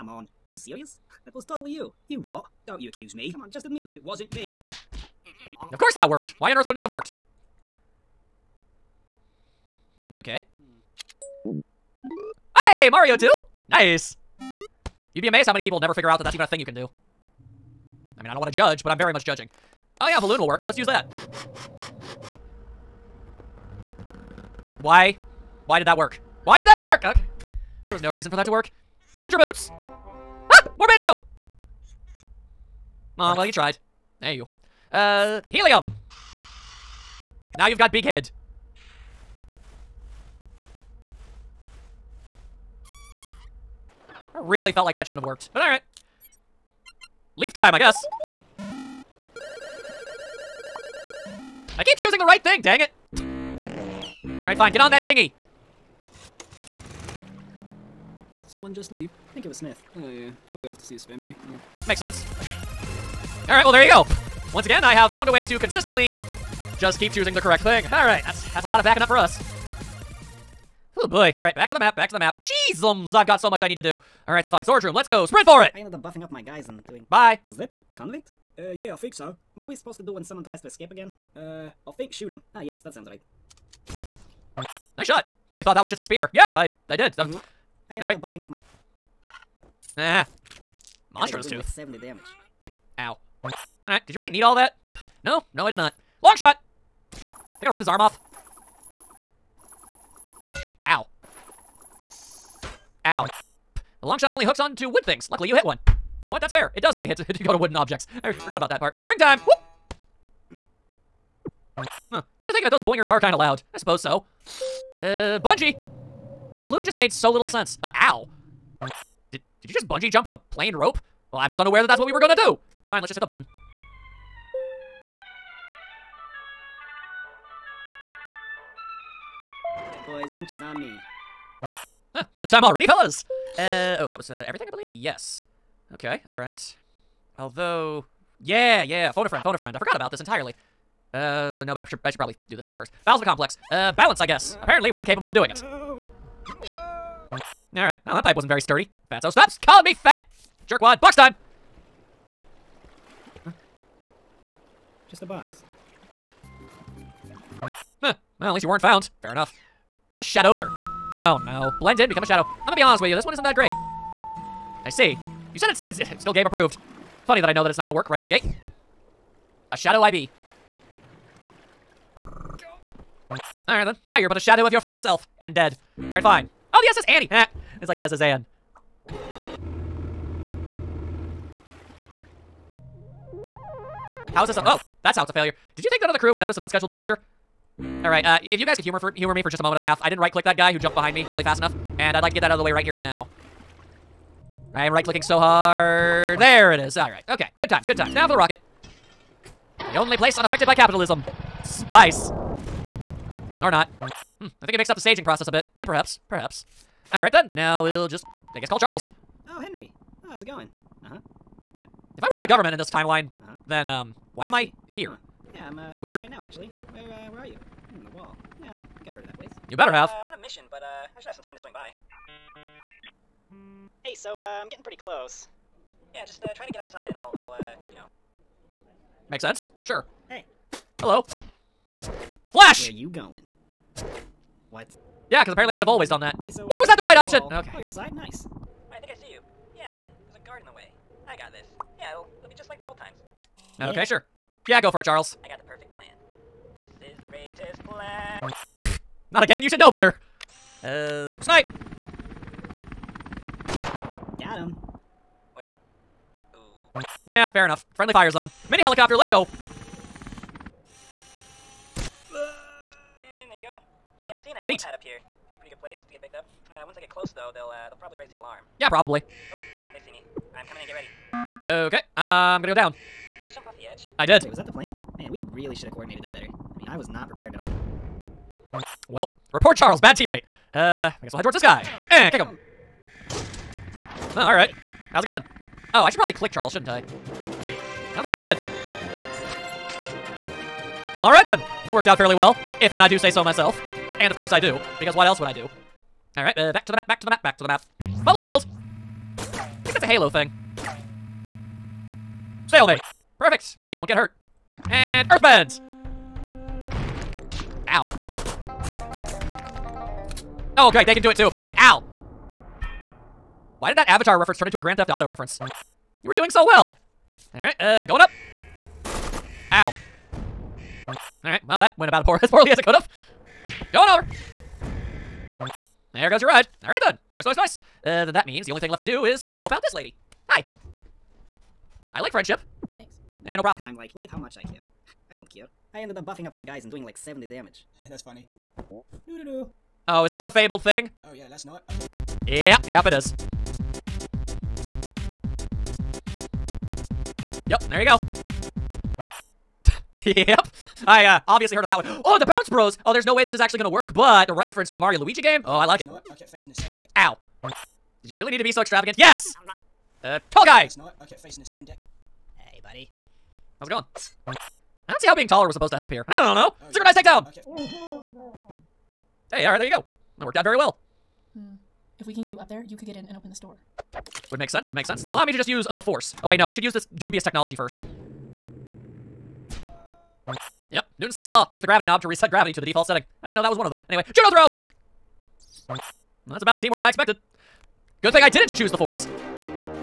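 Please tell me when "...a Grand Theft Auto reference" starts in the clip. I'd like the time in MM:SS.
05:14.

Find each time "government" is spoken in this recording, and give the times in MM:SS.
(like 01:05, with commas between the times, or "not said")
03:32.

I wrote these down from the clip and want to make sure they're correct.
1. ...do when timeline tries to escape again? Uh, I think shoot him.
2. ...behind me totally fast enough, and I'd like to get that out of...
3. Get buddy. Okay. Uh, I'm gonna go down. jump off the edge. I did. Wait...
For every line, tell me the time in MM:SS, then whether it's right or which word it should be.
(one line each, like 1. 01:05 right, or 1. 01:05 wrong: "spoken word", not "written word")
1. 01:20 wrong: "someone", not "timeline"
2. 03:10 wrong: "nearly", not "totally"
3. 04:30 wrong: "ready", not "buddy".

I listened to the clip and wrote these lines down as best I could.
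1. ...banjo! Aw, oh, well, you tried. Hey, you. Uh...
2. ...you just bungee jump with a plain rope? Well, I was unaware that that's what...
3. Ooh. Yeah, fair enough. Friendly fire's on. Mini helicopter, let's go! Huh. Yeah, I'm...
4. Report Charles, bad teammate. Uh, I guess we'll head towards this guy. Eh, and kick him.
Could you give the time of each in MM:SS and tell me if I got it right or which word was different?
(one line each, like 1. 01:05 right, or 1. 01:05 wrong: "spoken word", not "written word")
1. 00:30 right
2. 01:59 right
3. 04:16 right
4. 04:39 right.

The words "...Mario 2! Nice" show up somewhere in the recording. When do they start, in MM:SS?
00:12.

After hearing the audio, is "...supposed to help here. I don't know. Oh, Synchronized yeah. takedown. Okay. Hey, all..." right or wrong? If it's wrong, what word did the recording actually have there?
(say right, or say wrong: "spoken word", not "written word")
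right.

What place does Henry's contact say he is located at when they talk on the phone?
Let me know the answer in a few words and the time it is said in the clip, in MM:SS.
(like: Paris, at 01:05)
the wall, at 03:38.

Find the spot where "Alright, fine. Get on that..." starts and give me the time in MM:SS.
00:54.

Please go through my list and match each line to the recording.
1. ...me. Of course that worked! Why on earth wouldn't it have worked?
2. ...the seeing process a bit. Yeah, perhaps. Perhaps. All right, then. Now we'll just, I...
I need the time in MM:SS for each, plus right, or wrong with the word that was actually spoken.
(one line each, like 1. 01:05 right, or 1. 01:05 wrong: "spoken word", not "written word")
1. 00:04 right
2. 03:24 wrong: "staging", not "seeing".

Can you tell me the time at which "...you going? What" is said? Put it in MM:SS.
03:52.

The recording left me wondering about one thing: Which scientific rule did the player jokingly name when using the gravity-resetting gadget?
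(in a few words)
Newton's sixth law.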